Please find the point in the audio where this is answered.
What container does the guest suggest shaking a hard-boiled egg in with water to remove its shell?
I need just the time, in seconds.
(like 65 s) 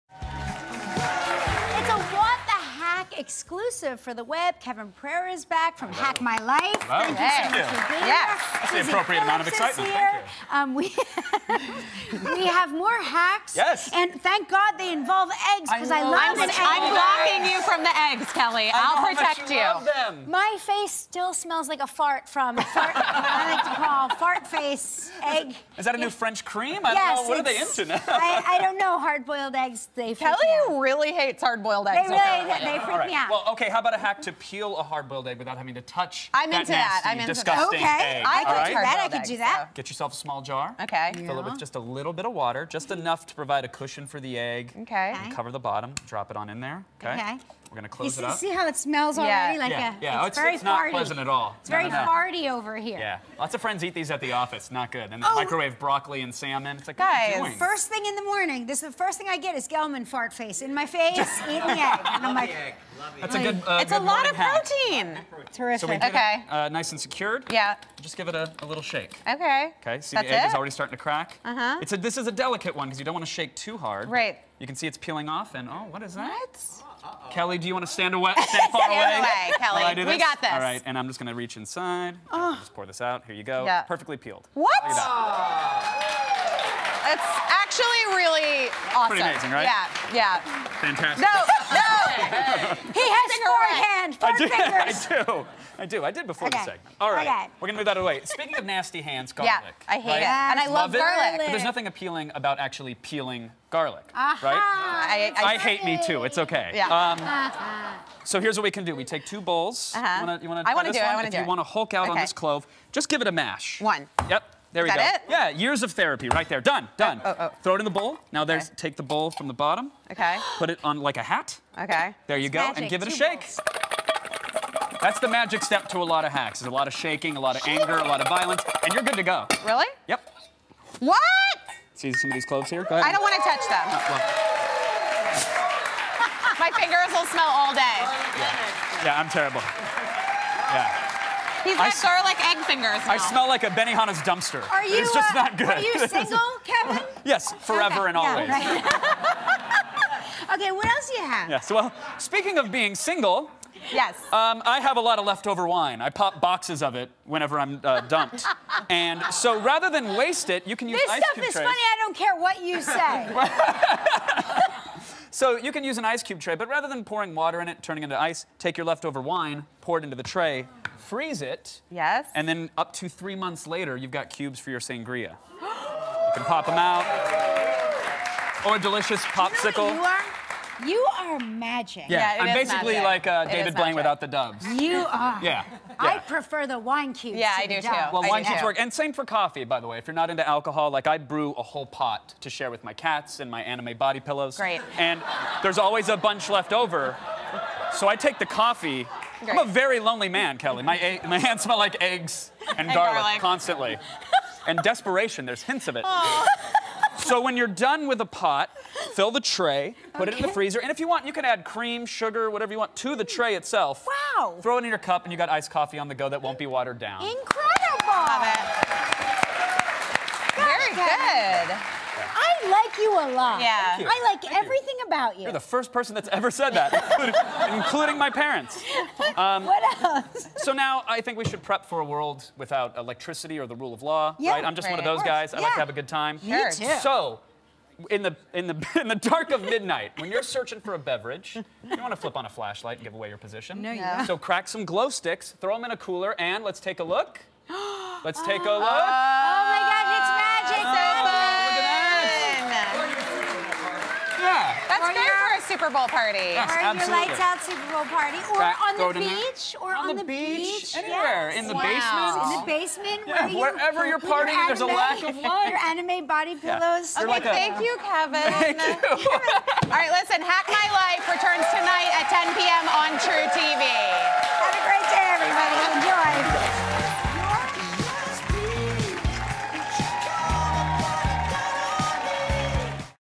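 40 s.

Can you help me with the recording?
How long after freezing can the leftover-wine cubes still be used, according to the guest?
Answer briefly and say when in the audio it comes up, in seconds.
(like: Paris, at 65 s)
3 months, at 173 s.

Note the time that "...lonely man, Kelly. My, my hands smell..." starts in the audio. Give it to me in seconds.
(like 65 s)
199 s.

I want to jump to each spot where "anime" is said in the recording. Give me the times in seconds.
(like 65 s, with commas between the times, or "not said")
193 s, 265 s.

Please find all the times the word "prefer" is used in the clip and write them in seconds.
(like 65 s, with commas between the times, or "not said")
186 s.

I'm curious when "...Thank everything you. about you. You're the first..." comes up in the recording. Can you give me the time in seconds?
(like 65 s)
224 s.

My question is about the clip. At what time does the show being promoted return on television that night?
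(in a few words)
10 p.m.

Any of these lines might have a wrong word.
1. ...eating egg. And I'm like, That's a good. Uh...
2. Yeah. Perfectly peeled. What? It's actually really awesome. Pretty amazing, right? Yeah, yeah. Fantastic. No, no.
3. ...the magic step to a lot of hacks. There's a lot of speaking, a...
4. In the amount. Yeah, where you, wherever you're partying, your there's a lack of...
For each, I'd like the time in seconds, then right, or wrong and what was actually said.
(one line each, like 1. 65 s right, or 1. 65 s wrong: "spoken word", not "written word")
1. 61 s right
2. 83 s right
3. 125 s wrong: "shaking", not "speaking"
4. 262 s wrong: "basement", not "amount".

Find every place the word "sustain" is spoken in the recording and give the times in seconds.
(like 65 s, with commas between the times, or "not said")
not said.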